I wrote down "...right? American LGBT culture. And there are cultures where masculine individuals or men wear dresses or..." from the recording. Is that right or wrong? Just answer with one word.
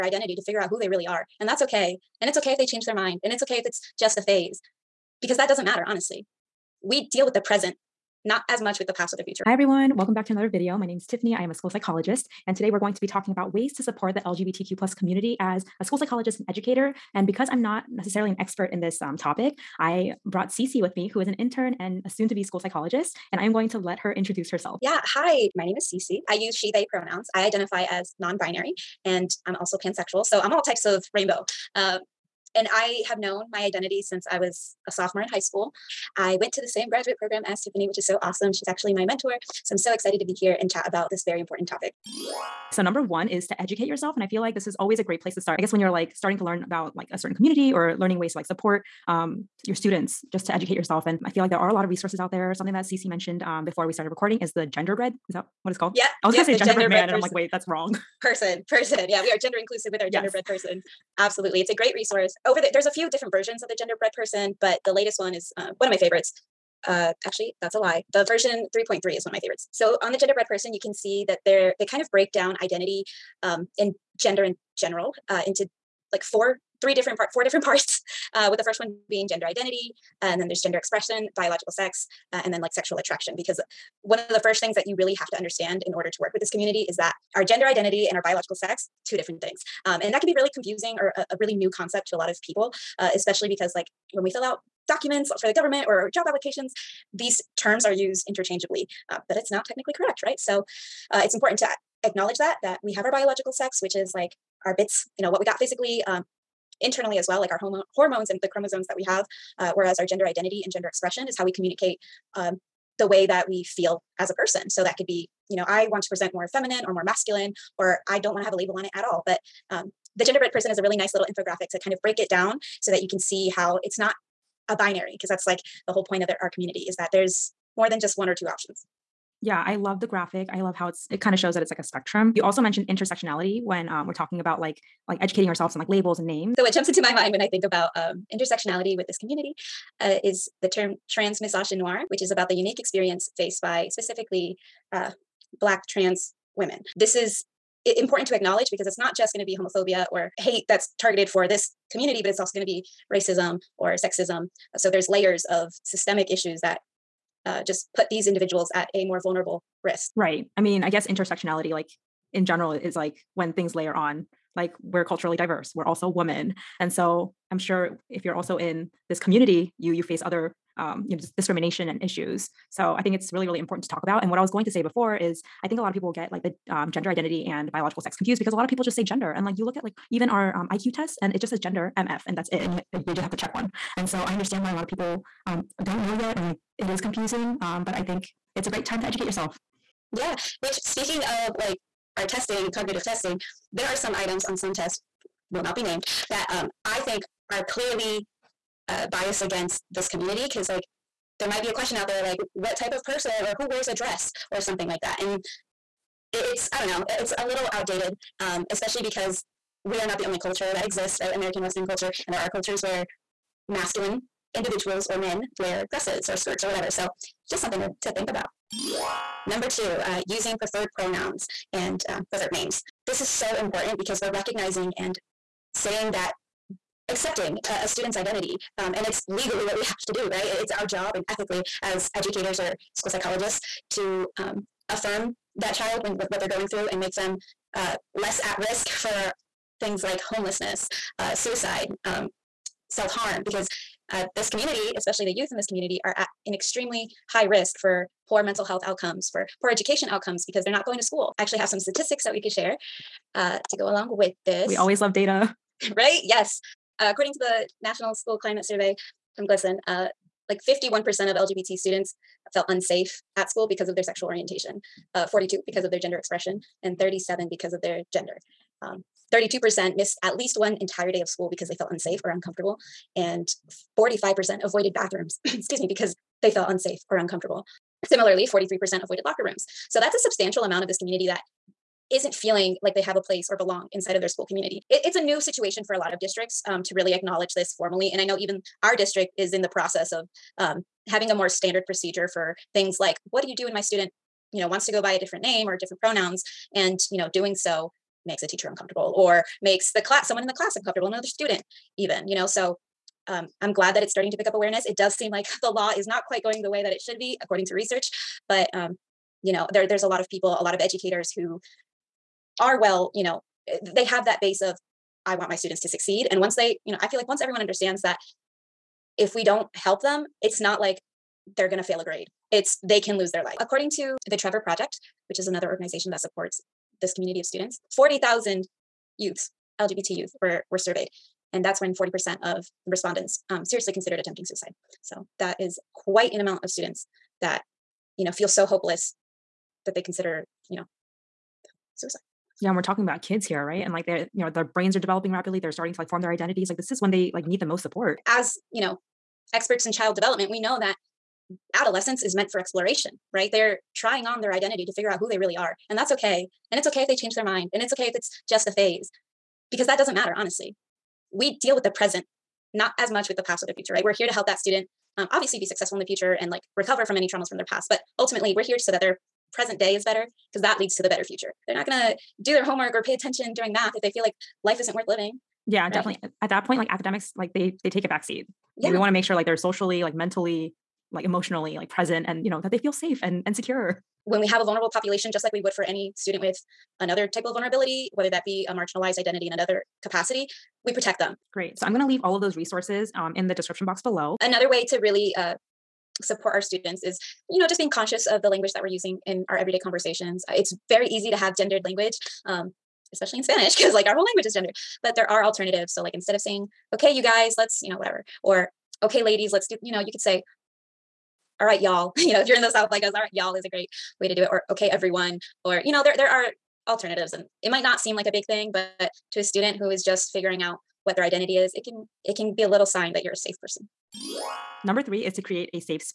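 wrong.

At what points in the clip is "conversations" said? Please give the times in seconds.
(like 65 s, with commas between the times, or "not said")
399 s.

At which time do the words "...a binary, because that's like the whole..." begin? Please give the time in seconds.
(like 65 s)
124 s.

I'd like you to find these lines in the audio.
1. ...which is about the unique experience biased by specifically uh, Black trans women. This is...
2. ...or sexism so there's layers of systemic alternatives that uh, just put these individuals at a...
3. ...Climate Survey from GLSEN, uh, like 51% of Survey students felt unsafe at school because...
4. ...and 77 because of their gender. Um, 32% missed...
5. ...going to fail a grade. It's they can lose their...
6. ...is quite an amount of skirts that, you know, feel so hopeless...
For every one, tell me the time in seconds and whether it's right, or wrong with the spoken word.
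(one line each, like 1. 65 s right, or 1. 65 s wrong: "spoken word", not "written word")
1. 142 s wrong: "faced", not "biased"
2. 153 s wrong: "issues", not "alternatives"
3. 258 s wrong: "LGBT", not "Survey"
4. 266 s wrong: "37", not "77"
5. 321 s right
6. 335 s wrong: "students", not "skirts".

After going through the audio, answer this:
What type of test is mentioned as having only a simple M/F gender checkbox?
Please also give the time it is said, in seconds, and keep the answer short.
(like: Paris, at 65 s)
IQ test, at 180 s.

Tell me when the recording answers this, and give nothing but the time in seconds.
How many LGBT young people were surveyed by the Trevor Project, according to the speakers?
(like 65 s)
327 s.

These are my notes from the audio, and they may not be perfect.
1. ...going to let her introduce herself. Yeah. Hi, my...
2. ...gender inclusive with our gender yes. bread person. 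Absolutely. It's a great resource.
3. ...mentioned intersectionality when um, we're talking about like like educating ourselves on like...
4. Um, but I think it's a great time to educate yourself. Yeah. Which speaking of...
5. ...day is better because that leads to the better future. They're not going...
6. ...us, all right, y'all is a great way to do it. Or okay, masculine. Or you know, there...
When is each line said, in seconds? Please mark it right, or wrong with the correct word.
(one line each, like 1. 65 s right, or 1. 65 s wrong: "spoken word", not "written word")
1. 23 s right
2. 59 s right
3. 132 s right
4. 187 s right
5. 369 s right
6. 413 s wrong: "everyone", not "masculine".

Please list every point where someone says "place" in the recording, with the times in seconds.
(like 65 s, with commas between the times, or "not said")
45 s, 283 s.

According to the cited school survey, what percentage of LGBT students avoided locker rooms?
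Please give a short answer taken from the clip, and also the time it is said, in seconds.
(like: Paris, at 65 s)
43%, at 278 s.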